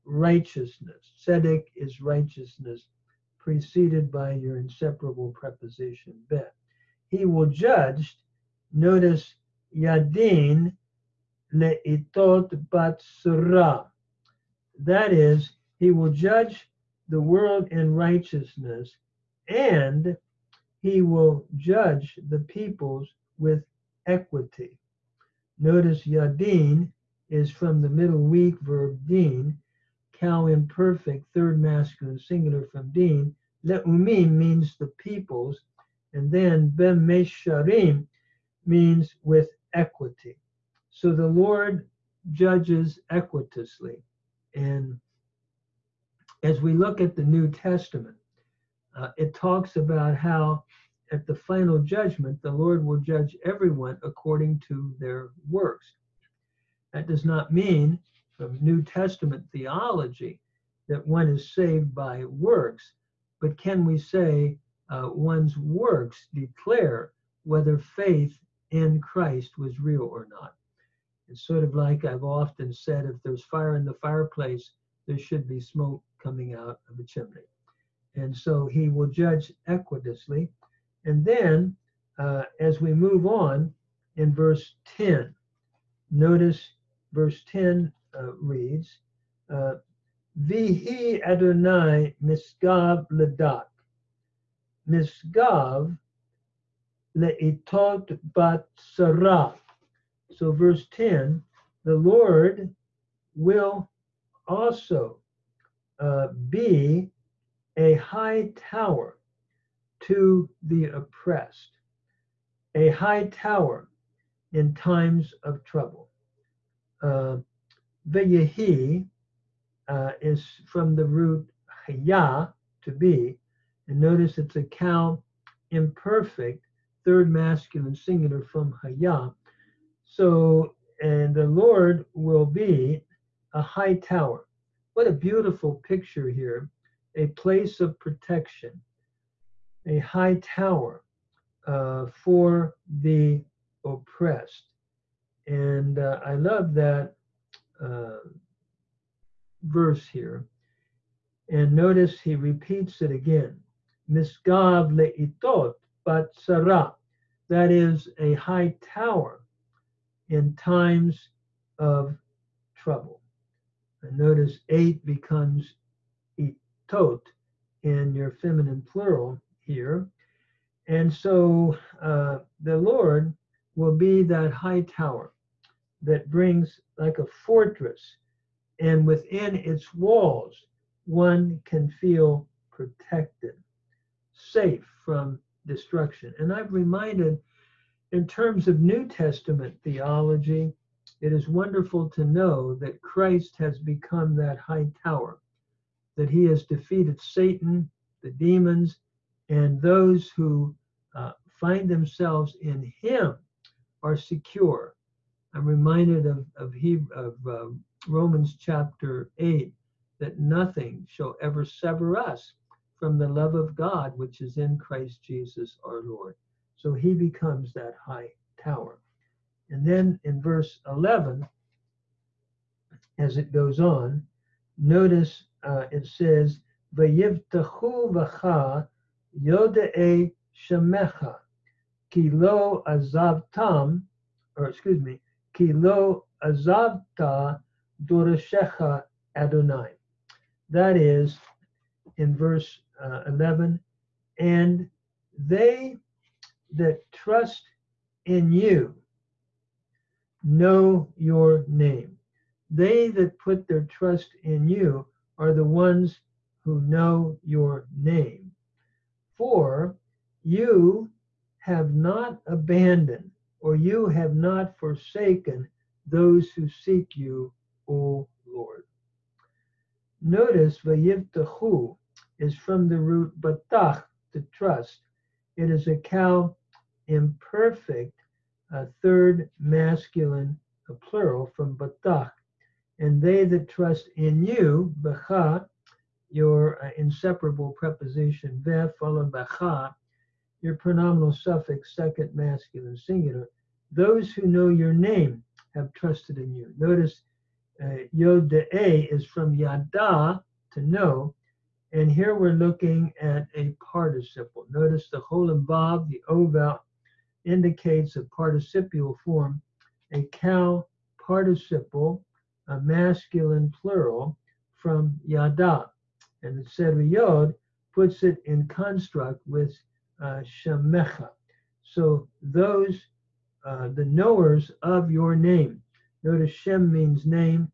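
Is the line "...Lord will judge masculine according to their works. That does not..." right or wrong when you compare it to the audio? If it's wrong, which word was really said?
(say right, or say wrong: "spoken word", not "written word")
wrong: "everyone", not "masculine".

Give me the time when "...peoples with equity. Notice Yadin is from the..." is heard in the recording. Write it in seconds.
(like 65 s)
22 s.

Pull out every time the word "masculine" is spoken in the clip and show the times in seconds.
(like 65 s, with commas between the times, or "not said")
31 s, 127 s, 279 s, 292 s, 312 s.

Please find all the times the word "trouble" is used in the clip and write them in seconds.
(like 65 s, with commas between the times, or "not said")
115 s, 162 s.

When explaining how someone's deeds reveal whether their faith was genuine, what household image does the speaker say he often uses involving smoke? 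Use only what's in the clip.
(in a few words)
fire in the fireplace.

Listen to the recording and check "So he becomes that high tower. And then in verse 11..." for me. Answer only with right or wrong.
right.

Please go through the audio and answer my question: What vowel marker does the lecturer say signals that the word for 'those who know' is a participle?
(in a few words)
Cholam Vav.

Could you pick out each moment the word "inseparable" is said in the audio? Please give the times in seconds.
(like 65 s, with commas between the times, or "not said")
4 s, 286 s.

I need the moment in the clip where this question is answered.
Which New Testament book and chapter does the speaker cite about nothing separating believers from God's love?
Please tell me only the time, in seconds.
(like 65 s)
208 s.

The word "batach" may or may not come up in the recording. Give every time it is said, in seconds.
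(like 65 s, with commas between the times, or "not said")
273 s, 281 s.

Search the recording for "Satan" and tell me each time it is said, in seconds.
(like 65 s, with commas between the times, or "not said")
197 s.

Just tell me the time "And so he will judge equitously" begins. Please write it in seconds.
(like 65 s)
78 s.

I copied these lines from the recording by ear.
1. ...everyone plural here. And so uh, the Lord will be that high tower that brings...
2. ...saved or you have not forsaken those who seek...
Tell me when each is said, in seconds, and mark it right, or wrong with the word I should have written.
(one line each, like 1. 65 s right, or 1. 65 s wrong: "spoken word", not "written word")
1. 168 s wrong: "feminine", not "everyone"
2. 262 s wrong: "abandoned", not "saved".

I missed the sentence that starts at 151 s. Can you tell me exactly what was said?
And notice he repeats it again.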